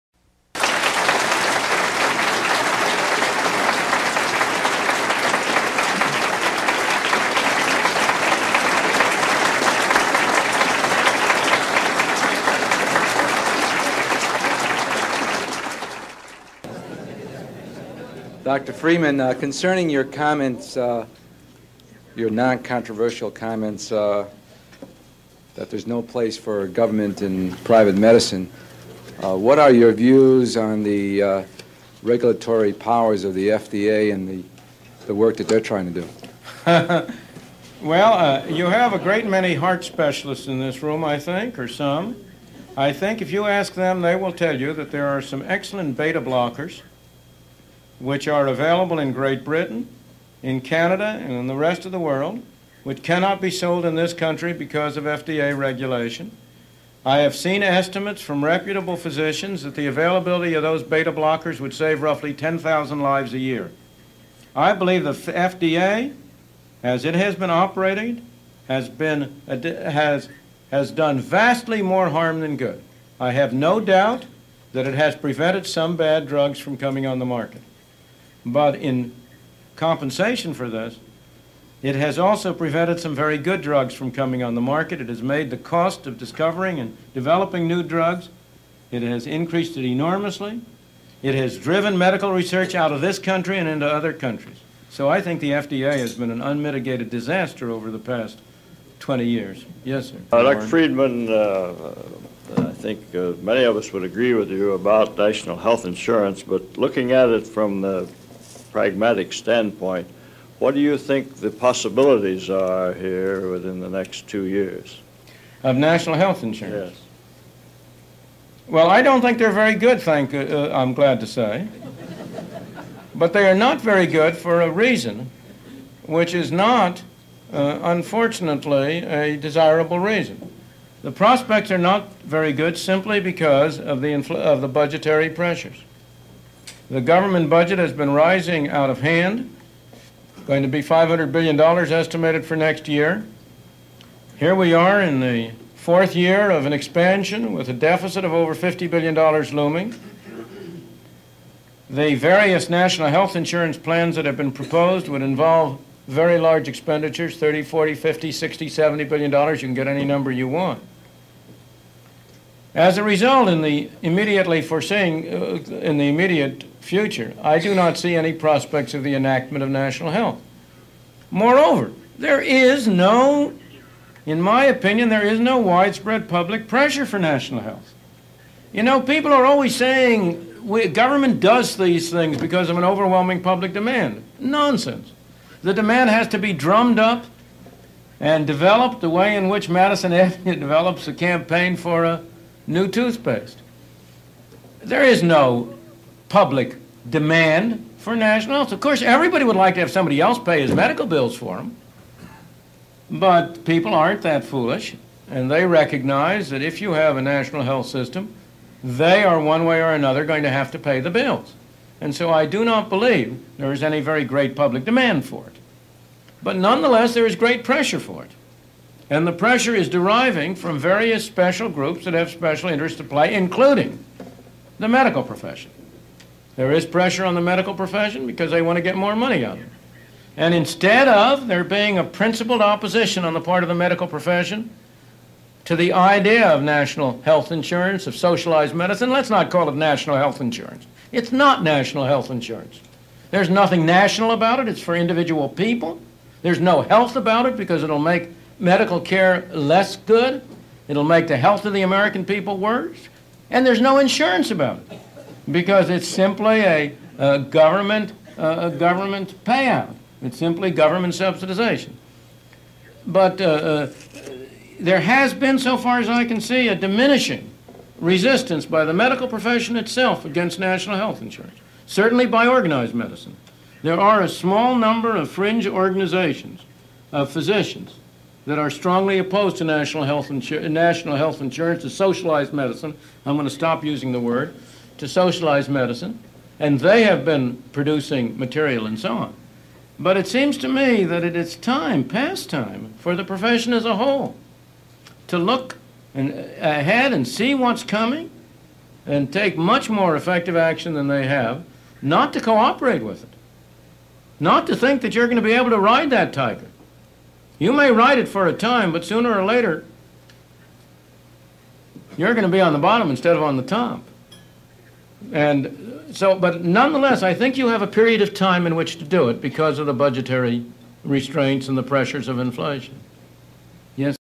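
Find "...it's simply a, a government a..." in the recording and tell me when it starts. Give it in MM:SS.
04:15.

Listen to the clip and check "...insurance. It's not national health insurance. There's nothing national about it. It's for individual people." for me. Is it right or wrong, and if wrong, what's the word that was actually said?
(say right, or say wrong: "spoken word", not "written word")
right.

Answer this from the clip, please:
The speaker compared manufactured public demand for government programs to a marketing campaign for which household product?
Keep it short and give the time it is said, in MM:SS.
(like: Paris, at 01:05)
Toothpaste, at 03:12.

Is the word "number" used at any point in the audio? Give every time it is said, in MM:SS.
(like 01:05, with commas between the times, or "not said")
02:40, 04:34.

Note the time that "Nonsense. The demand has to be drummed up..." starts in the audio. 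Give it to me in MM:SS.
03:04.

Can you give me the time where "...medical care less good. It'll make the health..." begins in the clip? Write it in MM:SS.
04:08.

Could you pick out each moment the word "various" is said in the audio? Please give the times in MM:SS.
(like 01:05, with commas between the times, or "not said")
02:32, 03:40.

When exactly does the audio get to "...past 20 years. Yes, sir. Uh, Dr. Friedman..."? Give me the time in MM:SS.
01:37.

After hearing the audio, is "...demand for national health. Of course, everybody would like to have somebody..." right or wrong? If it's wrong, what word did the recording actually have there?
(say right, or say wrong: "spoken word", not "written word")
right.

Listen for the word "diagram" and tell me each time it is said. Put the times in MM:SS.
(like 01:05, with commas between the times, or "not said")
not said.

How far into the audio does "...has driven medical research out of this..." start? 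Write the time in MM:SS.
01:31.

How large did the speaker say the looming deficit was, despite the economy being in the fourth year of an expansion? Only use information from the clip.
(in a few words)
Over $50 billion.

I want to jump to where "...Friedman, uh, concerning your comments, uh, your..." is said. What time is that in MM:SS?
00:18.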